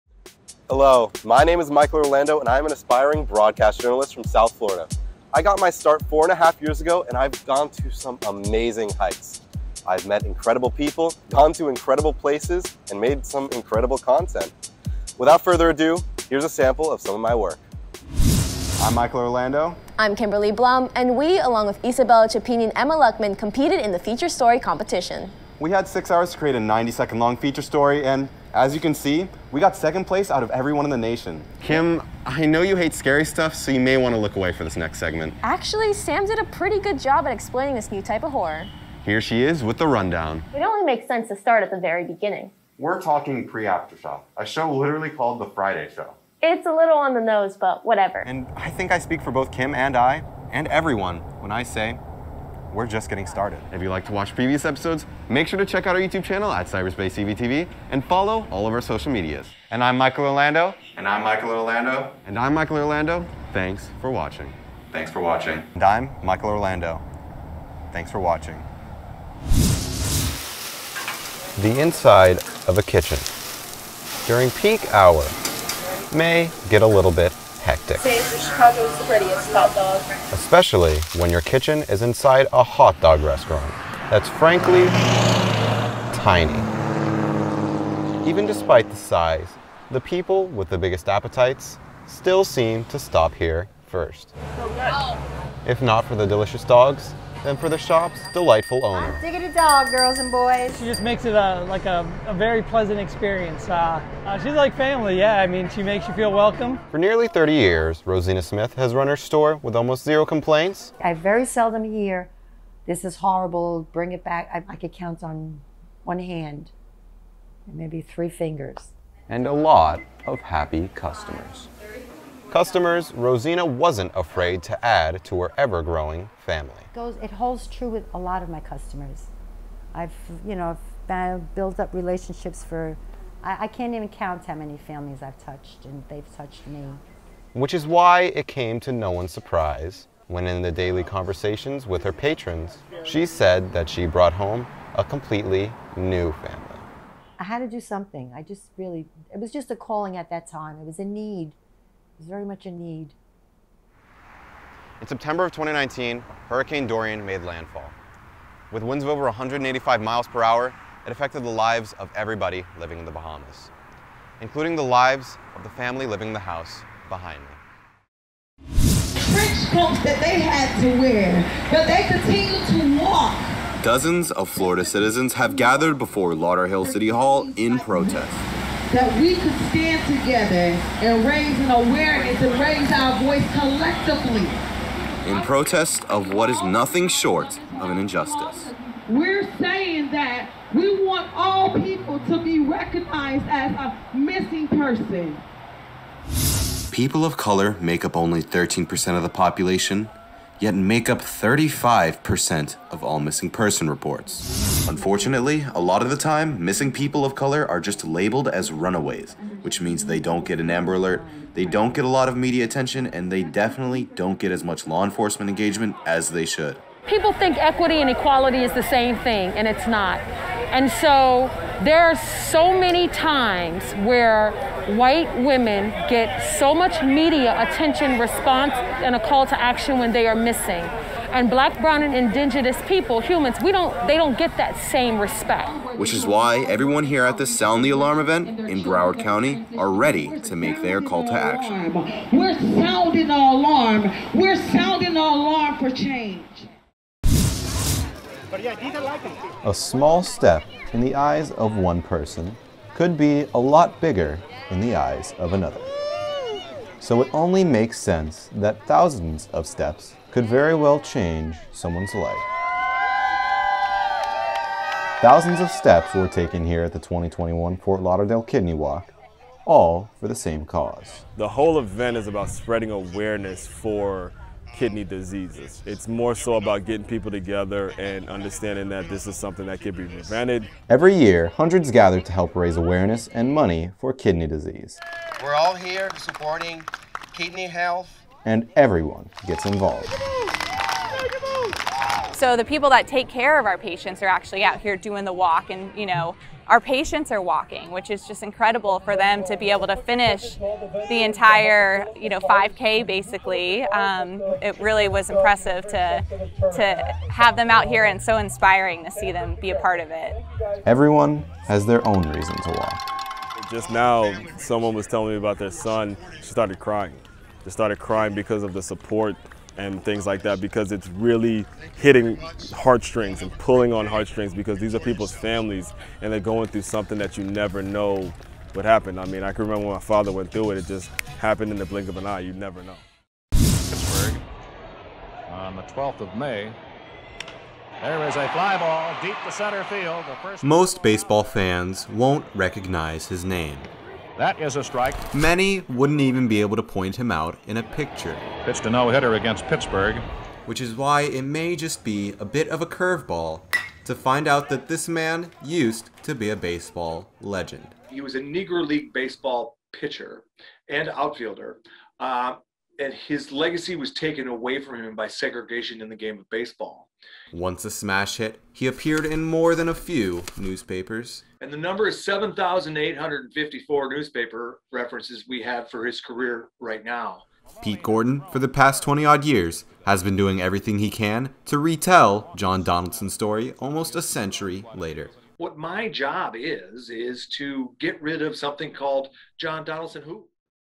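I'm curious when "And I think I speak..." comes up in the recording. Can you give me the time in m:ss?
0:48.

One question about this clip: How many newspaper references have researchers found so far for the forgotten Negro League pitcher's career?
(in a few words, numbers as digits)
7,854.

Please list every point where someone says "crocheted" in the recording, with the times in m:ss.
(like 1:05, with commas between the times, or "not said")
not said.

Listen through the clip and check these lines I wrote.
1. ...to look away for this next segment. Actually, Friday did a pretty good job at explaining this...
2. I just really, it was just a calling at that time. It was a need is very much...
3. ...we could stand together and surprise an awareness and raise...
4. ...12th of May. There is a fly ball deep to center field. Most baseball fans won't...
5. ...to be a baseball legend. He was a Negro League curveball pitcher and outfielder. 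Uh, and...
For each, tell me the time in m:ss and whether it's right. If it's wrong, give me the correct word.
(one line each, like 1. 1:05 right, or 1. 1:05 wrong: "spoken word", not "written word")
1. 0:34 wrong: "Sam", not "Friday"
2. 2:28 right
3. 2:59 wrong: "raise", not "surprise"
4. 5:35 right
5. 5:56 wrong: "baseball", not "curveball".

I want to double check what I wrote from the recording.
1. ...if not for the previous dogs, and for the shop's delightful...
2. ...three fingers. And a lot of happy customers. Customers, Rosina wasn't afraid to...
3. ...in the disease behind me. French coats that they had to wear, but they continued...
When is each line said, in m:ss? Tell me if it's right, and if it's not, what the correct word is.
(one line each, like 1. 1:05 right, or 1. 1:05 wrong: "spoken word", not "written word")
1. 1:35 wrong: "delicious", not "previous"
2. 1:58 right
3. 2:46 wrong: "house", not "disease".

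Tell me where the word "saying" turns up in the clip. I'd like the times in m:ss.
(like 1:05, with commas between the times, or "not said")
3:09.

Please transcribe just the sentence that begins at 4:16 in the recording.
So it only makes sense that thousands of steps could very well change someone's life.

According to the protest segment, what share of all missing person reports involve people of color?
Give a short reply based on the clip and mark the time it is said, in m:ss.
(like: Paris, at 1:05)
35%, at 3:21.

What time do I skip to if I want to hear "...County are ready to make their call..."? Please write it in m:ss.
3:59.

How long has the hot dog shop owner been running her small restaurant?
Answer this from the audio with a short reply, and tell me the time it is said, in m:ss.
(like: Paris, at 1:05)
nearly 30 years, at 1:46.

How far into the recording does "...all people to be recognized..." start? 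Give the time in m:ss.
3:11.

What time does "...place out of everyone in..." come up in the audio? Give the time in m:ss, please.
0:30.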